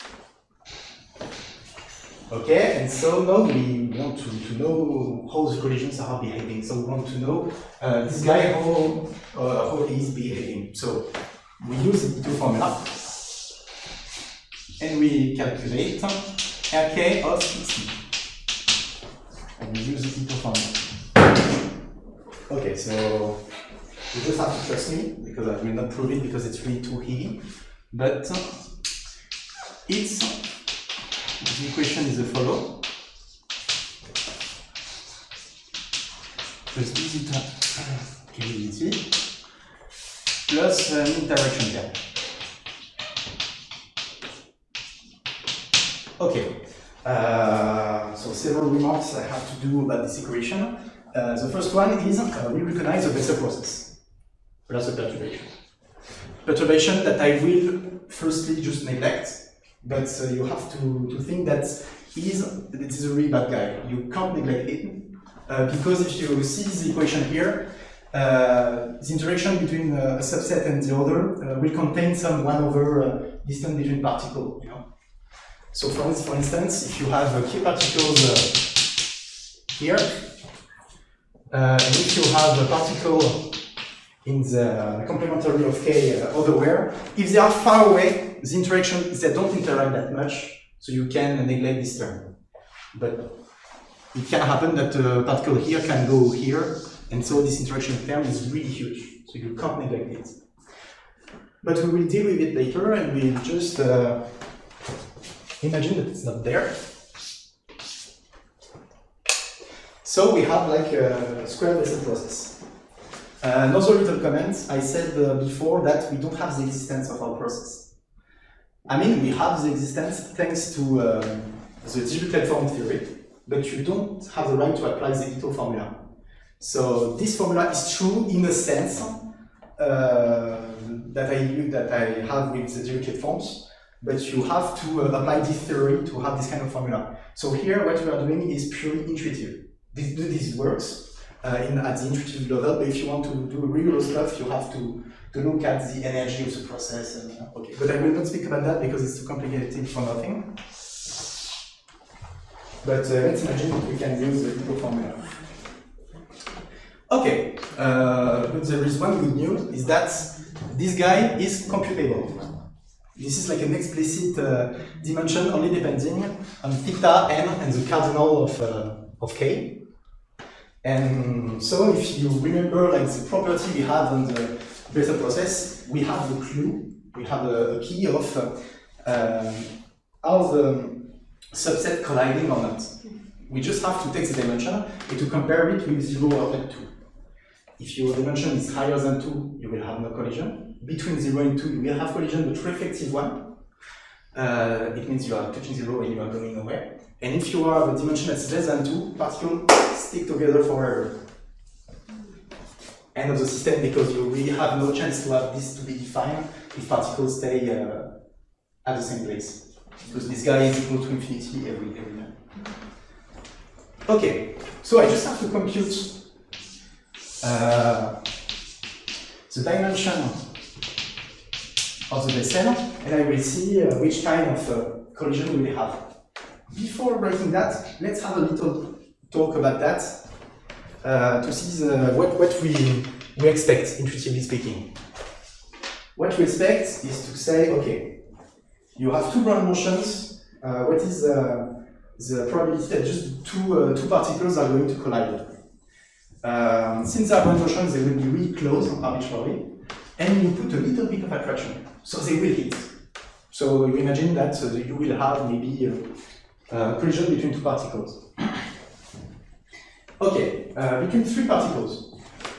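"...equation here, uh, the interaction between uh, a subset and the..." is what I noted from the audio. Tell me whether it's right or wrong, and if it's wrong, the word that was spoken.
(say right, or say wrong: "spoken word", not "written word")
right.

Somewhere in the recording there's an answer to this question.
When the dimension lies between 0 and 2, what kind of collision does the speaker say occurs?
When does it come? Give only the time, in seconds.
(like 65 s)
192 s.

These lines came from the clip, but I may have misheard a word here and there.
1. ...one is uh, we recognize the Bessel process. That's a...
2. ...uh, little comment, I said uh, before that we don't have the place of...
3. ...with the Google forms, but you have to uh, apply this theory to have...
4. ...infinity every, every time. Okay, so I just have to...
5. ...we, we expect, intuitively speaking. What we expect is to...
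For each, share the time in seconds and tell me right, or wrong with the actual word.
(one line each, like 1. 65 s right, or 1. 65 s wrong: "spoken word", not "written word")
1. 51 s right
2. 113 s wrong: "existence", not "place"
3. 132 s wrong: "Dirichlet", not "Google"
4. 211 s right
5. 232 s right.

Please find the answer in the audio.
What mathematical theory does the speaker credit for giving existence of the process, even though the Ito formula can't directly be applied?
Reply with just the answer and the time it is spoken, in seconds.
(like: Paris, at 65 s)
Dirichlet form theory, at 122 s.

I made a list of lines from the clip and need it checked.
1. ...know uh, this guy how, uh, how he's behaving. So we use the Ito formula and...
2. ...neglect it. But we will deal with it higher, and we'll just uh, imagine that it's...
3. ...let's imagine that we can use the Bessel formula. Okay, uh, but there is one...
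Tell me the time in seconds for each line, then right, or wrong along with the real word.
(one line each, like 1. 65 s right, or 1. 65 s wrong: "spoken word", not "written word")
1. 7 s right
2. 99 s wrong: "later", not "higher"
3. 153 s wrong: "Google", not "Bessel".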